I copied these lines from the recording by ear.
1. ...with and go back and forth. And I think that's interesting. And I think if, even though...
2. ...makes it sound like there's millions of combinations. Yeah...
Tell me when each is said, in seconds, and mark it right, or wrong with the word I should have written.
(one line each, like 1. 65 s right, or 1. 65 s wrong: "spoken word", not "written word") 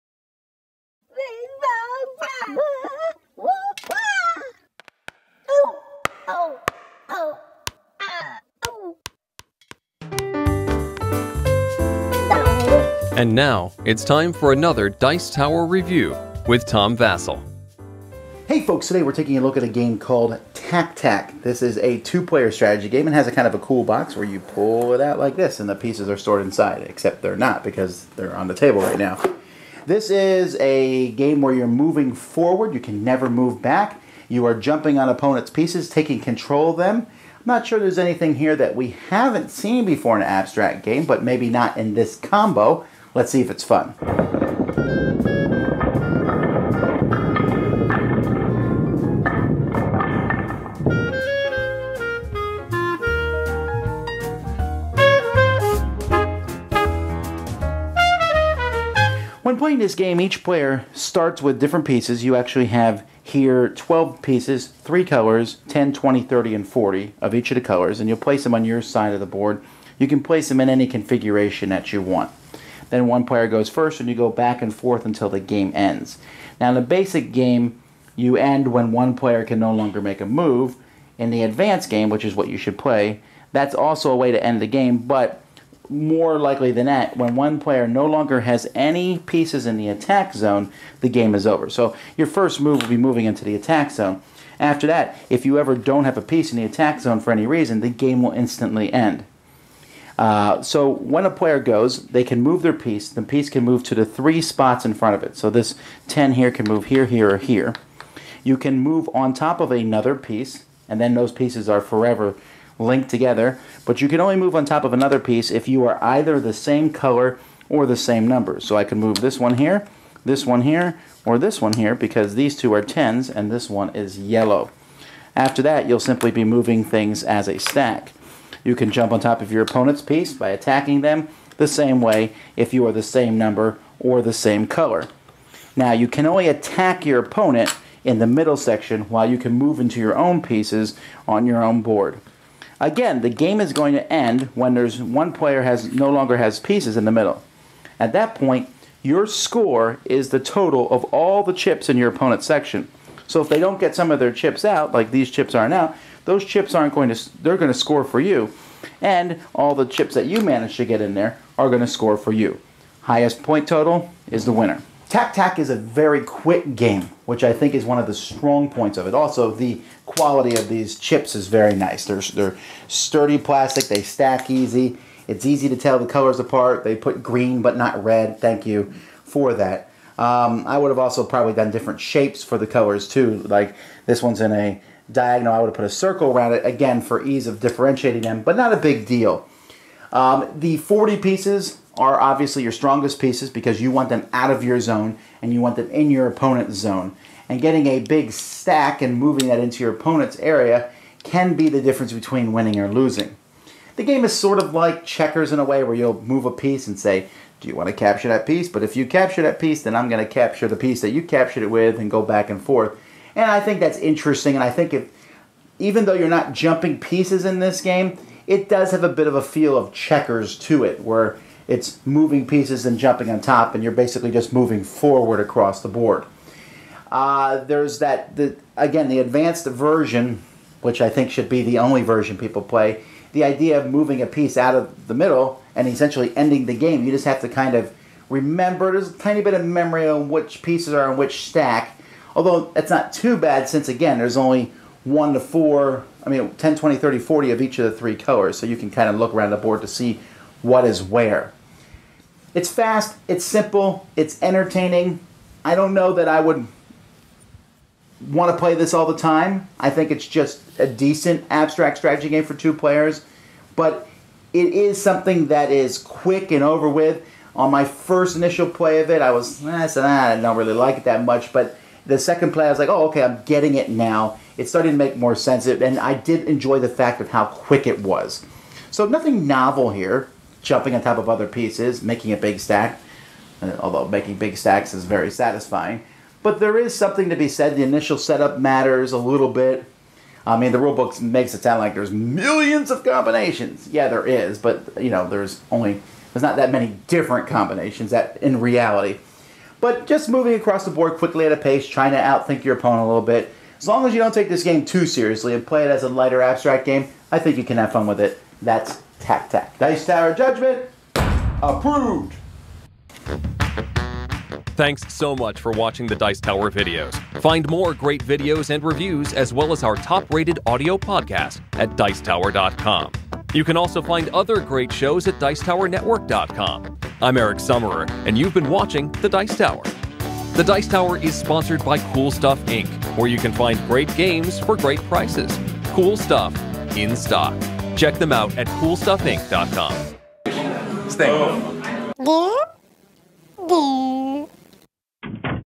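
1. 211 s right
2. 291 s right.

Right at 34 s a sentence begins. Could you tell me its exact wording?
You are jumping on opponents' pieces, taking control of them.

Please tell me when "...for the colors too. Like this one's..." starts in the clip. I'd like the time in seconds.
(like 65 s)
182 s.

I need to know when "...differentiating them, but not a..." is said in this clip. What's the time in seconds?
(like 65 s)
187 s.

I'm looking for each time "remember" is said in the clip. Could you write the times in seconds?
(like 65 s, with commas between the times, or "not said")
238 s.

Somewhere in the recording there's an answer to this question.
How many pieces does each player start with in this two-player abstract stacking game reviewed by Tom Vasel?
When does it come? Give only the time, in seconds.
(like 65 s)
63 s.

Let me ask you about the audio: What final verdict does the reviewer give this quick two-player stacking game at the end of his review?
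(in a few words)
approved.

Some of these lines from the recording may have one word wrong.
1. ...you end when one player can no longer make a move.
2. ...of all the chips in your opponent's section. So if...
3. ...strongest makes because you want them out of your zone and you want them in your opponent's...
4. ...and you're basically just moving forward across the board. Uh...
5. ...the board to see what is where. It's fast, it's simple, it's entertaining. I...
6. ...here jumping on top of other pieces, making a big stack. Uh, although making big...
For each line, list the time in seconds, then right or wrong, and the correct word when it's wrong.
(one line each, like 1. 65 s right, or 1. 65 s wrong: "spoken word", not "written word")
1. 78 s right
2. 150 s right
3. 192 s wrong: "pieces", not "makes"
4. 223 s right
5. 249 s right
6. 279 s right.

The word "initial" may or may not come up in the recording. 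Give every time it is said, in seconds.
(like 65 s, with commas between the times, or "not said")
268 s, 287 s.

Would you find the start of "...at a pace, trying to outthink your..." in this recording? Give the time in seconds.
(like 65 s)
301 s.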